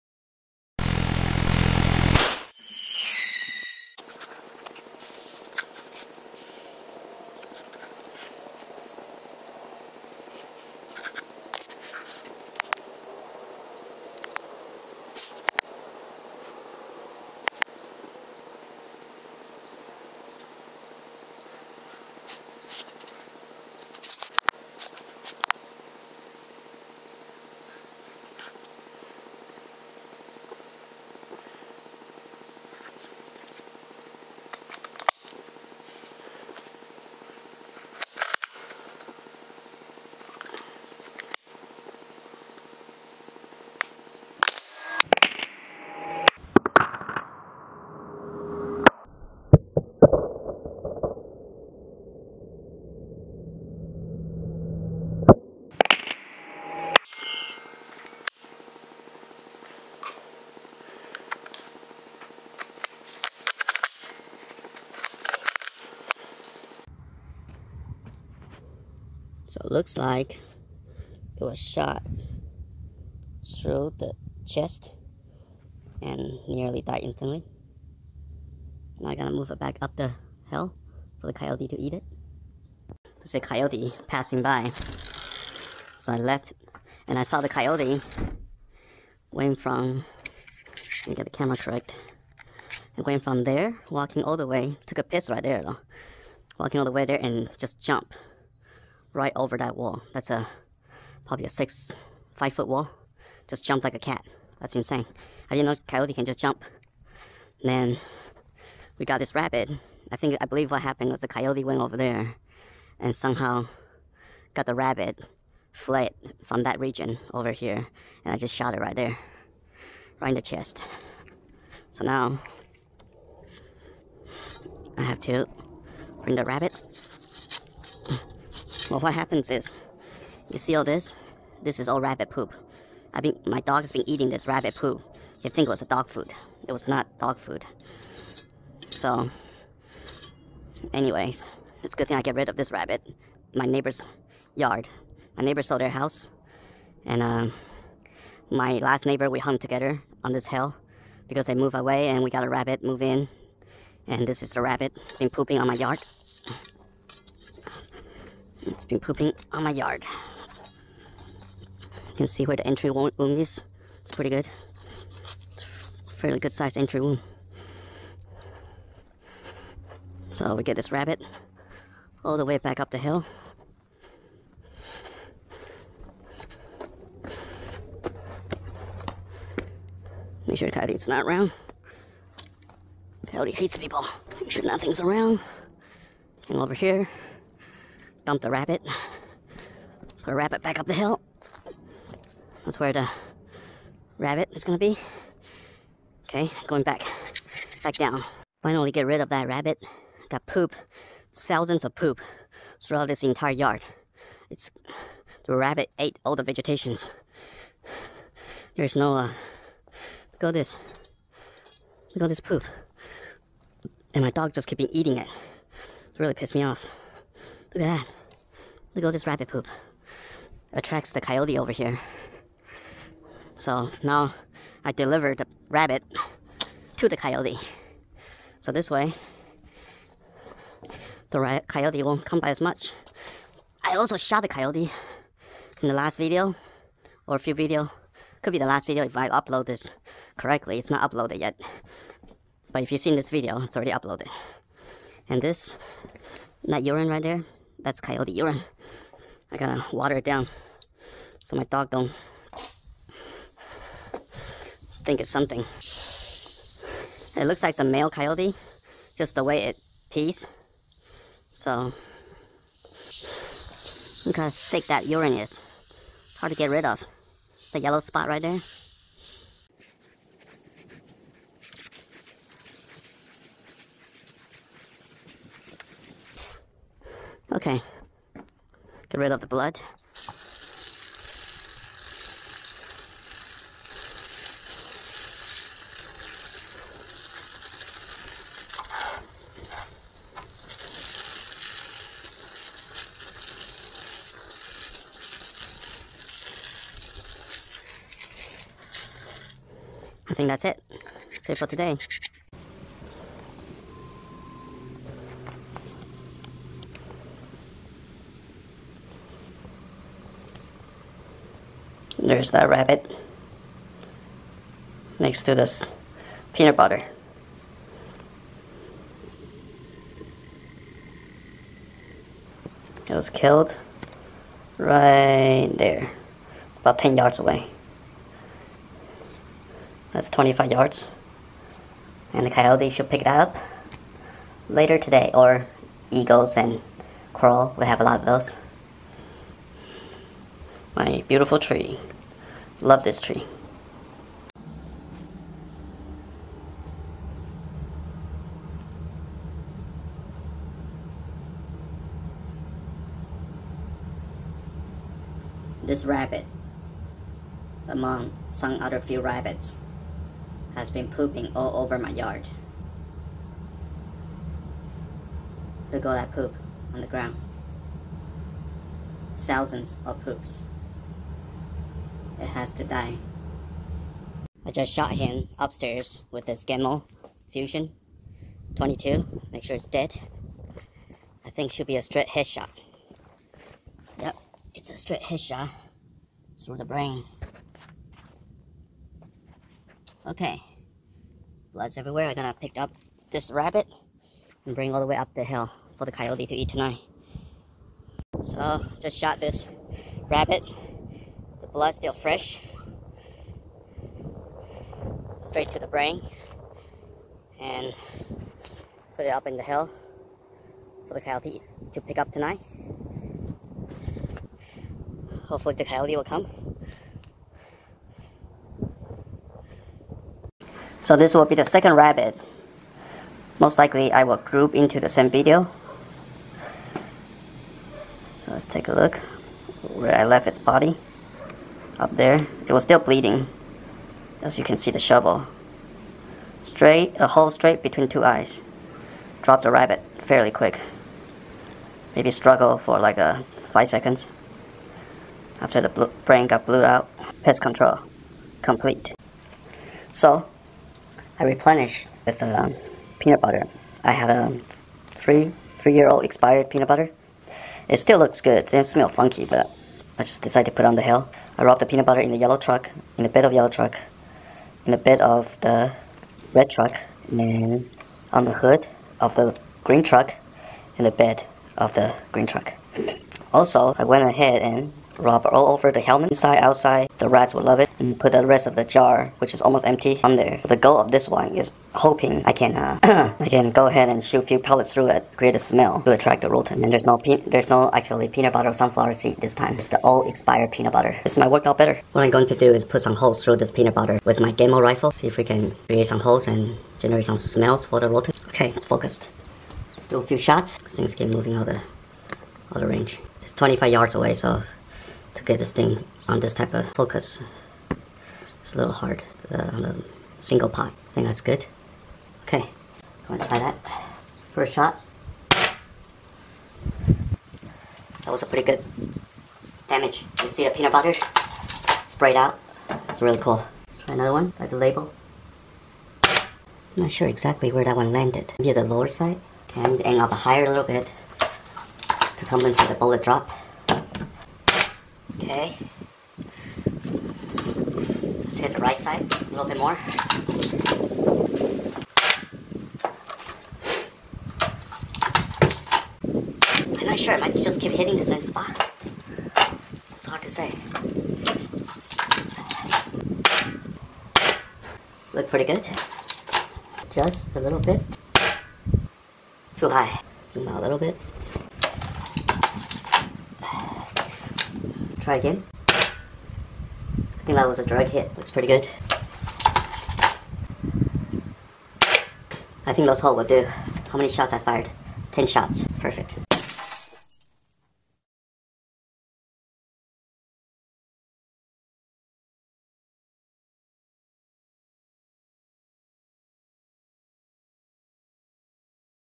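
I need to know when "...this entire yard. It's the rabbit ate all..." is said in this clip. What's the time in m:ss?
3:23.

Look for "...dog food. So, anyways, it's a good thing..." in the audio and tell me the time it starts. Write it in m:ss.
2:17.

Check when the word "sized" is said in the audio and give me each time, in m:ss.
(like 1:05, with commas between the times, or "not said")
2:46.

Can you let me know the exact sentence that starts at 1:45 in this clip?
I didn't know coyote can just jump.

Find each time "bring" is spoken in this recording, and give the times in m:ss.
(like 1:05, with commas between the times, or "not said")
2:06, 6:34.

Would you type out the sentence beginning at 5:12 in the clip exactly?
There's the rabbit next to this peanut butter.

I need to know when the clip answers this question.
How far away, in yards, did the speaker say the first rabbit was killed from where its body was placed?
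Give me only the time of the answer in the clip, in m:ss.
5:26.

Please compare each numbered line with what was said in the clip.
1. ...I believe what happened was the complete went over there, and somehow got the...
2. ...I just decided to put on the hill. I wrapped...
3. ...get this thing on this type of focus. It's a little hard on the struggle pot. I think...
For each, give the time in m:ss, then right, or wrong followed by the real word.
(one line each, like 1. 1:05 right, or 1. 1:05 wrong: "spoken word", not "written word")
1. 1:50 wrong: "coyote", not "complete"
2. 7:40 right
3. 8:25 wrong: "single", not "struggle".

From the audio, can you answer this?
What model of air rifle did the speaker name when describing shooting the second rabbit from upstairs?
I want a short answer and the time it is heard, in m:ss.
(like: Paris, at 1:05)
Gamo Fusion 22, at 6:16.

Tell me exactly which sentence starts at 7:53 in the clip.
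Also, I went ahead and rub all over the helmet, inside, outside.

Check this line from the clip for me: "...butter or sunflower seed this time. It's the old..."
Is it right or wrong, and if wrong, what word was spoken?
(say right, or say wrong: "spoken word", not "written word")
right.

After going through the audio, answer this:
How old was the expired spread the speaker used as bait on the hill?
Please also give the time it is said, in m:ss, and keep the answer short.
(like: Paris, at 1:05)
3 years, at 7:35.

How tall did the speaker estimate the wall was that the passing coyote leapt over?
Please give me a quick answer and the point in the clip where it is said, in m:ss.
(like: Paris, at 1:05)
5 feet, at 1:42.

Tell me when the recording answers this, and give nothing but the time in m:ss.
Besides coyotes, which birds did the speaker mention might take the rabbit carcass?
5:36.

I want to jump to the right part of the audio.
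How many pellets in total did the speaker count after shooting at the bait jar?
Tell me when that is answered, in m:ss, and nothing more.
9:35.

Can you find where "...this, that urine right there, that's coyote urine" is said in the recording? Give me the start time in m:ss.
4:05.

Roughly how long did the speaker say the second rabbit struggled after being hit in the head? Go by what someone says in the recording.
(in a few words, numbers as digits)
5 seconds.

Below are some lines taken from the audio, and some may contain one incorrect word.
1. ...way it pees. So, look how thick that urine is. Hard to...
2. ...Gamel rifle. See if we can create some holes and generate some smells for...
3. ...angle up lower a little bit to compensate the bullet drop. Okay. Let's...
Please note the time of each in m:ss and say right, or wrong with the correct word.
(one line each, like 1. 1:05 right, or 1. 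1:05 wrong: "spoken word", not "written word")
1. 4:19 right
2. 8:14 right
3. 8:50 wrong: "higher", not "lower".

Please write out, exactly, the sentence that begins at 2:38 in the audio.
It's been pooping on my yard.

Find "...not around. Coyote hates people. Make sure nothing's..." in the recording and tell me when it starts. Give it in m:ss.
3:01.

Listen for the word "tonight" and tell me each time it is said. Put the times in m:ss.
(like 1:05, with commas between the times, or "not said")
6:36, 6:52.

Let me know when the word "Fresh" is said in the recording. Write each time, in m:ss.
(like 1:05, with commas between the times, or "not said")
6:42.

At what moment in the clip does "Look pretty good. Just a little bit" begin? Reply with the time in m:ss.
9:15.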